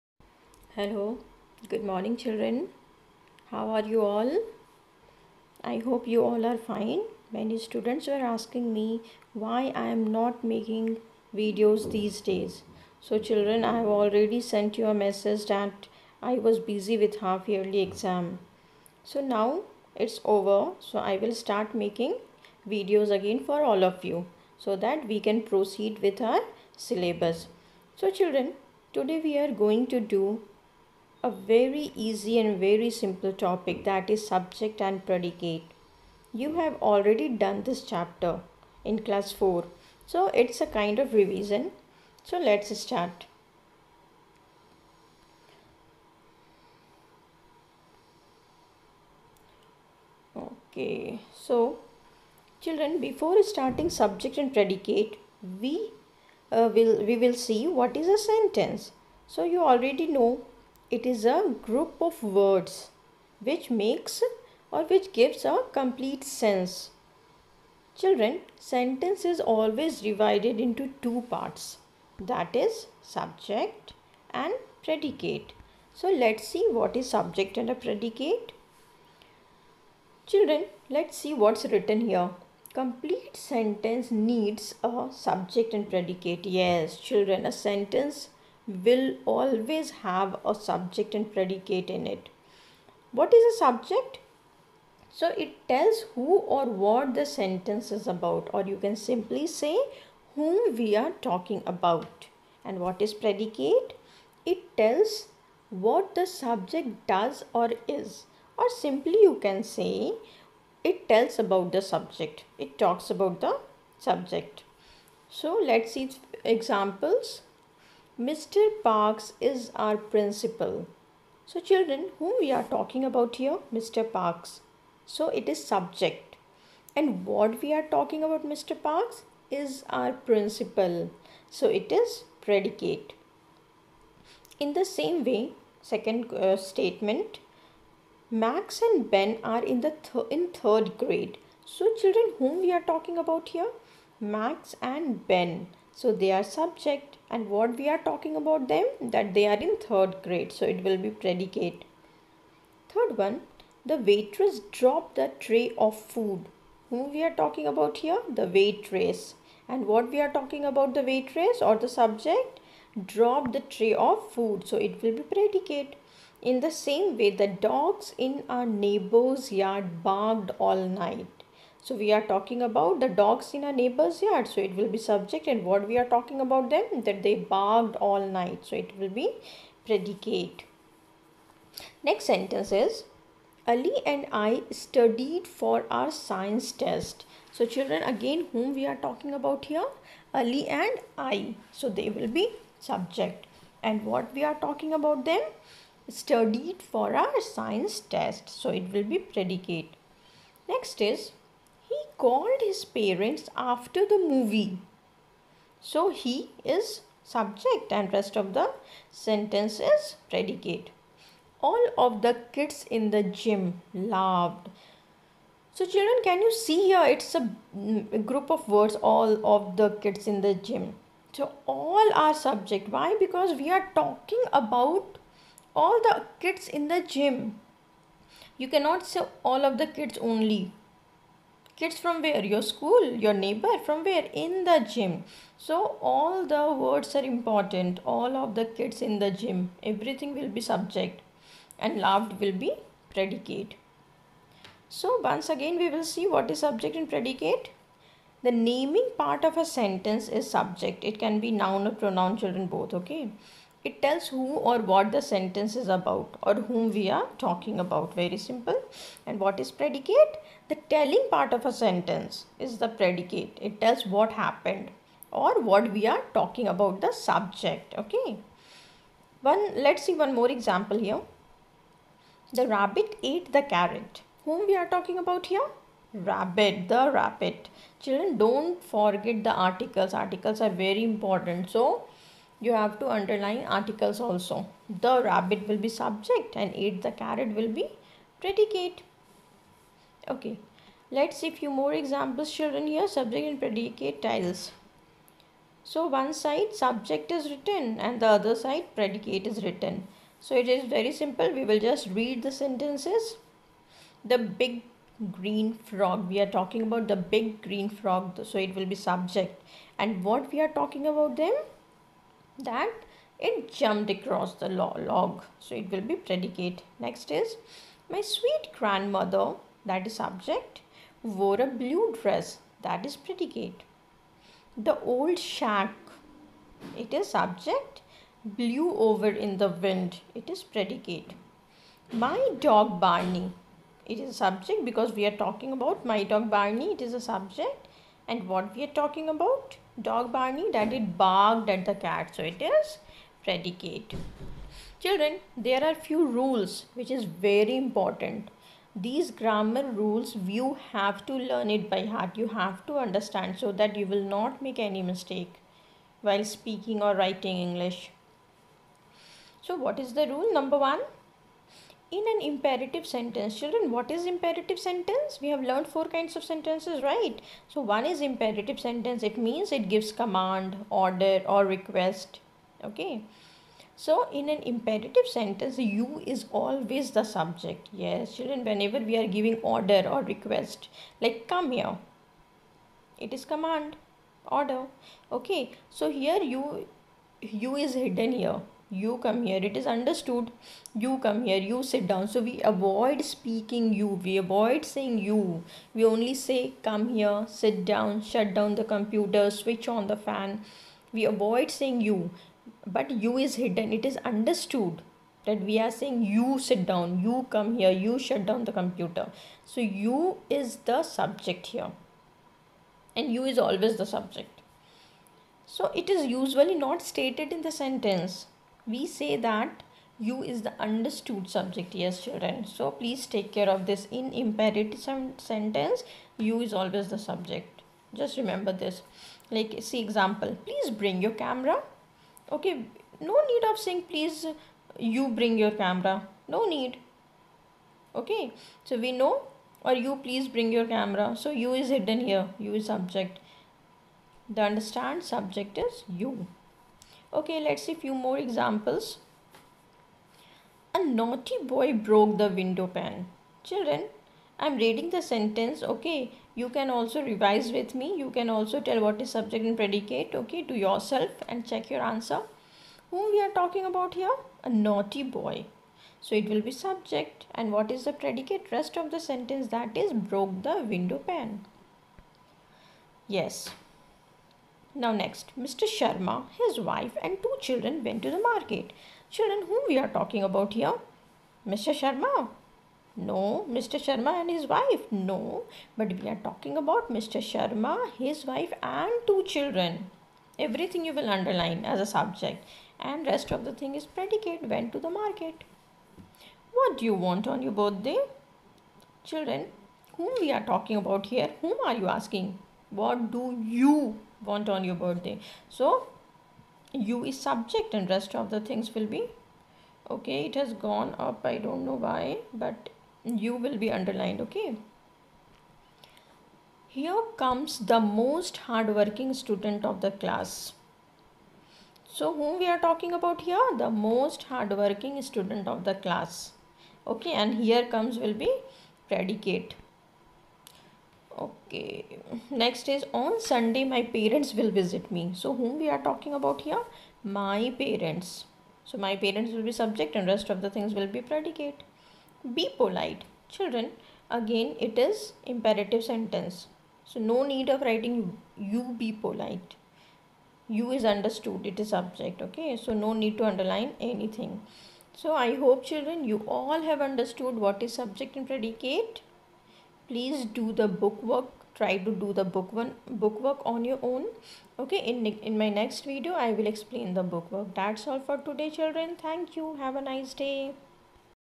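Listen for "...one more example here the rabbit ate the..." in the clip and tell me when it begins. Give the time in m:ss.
4:30.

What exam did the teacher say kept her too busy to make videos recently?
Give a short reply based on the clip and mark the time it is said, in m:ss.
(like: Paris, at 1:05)
Half yearly exam, at 0:17.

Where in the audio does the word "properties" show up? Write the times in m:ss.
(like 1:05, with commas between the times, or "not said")
not said.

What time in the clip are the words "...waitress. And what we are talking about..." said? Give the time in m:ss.
2:38.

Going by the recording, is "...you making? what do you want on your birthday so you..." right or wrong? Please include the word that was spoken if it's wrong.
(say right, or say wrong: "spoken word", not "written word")
wrong: "asking", not "making".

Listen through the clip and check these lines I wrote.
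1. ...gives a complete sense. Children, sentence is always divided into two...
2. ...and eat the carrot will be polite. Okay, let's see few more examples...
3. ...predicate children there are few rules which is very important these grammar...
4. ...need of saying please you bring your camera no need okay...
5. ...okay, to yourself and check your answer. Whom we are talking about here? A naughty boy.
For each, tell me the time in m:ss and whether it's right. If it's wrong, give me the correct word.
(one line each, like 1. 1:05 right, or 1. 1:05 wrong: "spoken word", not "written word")
1. 1:05 right
2. 4:46 wrong: "predicate", not "polite"
3. 5:43 right
4. 7:13 right
5. 7:40 right.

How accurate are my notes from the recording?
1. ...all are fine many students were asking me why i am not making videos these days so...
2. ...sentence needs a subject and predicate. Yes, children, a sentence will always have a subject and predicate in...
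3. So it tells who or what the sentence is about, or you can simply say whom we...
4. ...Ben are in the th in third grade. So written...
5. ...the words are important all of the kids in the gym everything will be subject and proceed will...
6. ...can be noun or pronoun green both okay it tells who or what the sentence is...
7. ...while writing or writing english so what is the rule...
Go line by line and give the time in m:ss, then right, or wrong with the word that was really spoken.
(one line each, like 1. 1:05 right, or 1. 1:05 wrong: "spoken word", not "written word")
1. 0:06 right
2. 1:23 right
3. 1:35 right
4. 2:19 wrong: "children", not "written"
5. 3:56 wrong: "loved", not "proceed"
6. 4:11 wrong: "children", not "green"
7. 5:56 wrong: "speaking", not "writing".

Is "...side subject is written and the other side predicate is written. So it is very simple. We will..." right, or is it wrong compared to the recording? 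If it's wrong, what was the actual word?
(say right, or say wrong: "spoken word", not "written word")
right.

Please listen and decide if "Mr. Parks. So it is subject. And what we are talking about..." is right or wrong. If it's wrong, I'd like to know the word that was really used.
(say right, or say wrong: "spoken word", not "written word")
right.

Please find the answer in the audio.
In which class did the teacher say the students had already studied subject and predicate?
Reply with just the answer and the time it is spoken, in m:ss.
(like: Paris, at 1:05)
Class 4, at 0:39.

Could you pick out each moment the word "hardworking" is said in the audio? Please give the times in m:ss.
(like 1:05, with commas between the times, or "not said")
8:38, 8:44.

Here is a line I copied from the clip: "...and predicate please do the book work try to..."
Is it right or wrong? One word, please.
right.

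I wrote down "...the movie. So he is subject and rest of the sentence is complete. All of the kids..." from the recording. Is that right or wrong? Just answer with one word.
wrong.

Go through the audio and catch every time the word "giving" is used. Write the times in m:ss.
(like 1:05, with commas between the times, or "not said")
6:19.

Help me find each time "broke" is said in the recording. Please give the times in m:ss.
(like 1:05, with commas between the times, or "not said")
7:31, 7:50.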